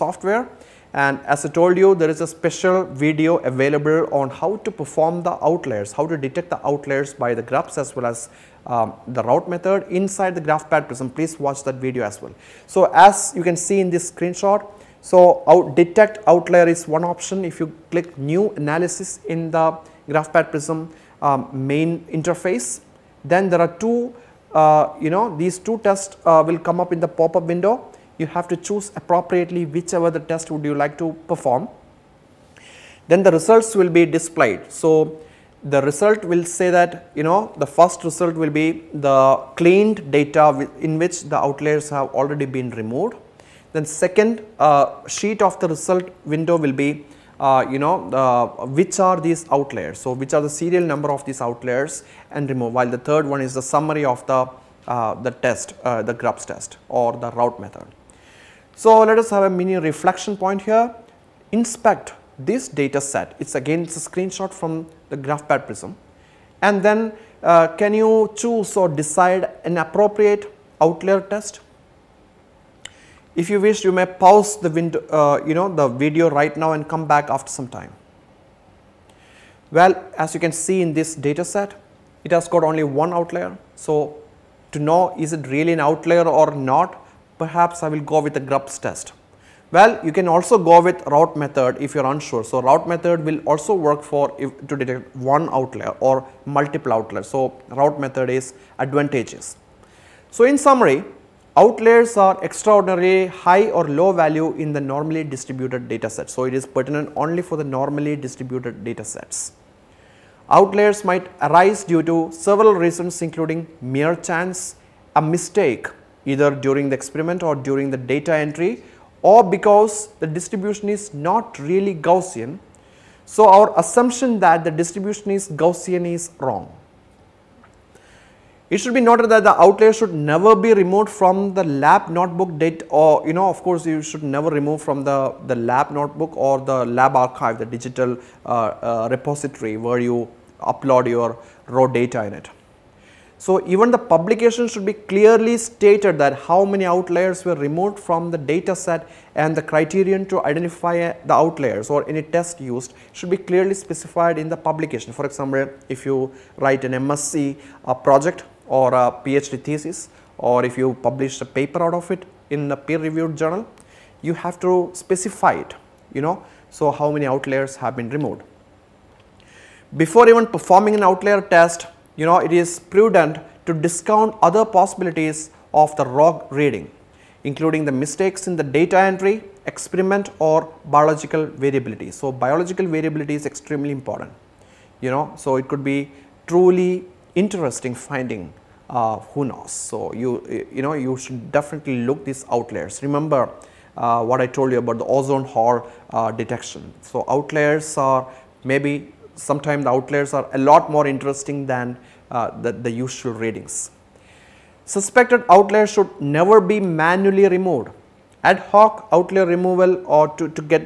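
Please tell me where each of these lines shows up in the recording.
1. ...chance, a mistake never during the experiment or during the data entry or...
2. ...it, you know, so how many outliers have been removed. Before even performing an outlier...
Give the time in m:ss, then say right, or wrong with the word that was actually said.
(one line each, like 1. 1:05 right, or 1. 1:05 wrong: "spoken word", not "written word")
1. 1:54 wrong: "either", not "never"
2. 2:45 right.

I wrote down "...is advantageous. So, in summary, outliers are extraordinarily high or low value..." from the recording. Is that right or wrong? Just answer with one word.
right.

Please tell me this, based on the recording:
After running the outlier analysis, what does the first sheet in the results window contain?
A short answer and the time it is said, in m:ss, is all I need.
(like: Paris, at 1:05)
the cleaned data, at 0:39.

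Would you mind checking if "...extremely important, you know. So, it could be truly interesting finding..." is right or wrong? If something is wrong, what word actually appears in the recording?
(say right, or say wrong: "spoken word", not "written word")
right.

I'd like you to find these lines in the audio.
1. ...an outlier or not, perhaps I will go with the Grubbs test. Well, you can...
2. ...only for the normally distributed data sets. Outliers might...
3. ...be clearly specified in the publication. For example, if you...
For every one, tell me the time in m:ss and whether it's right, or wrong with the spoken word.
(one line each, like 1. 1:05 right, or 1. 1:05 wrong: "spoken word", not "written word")
1. 1:25 right
2. 1:47 right
3. 2:33 right.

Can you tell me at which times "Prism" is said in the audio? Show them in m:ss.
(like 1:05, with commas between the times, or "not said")
0:10, 0:20, 1:05.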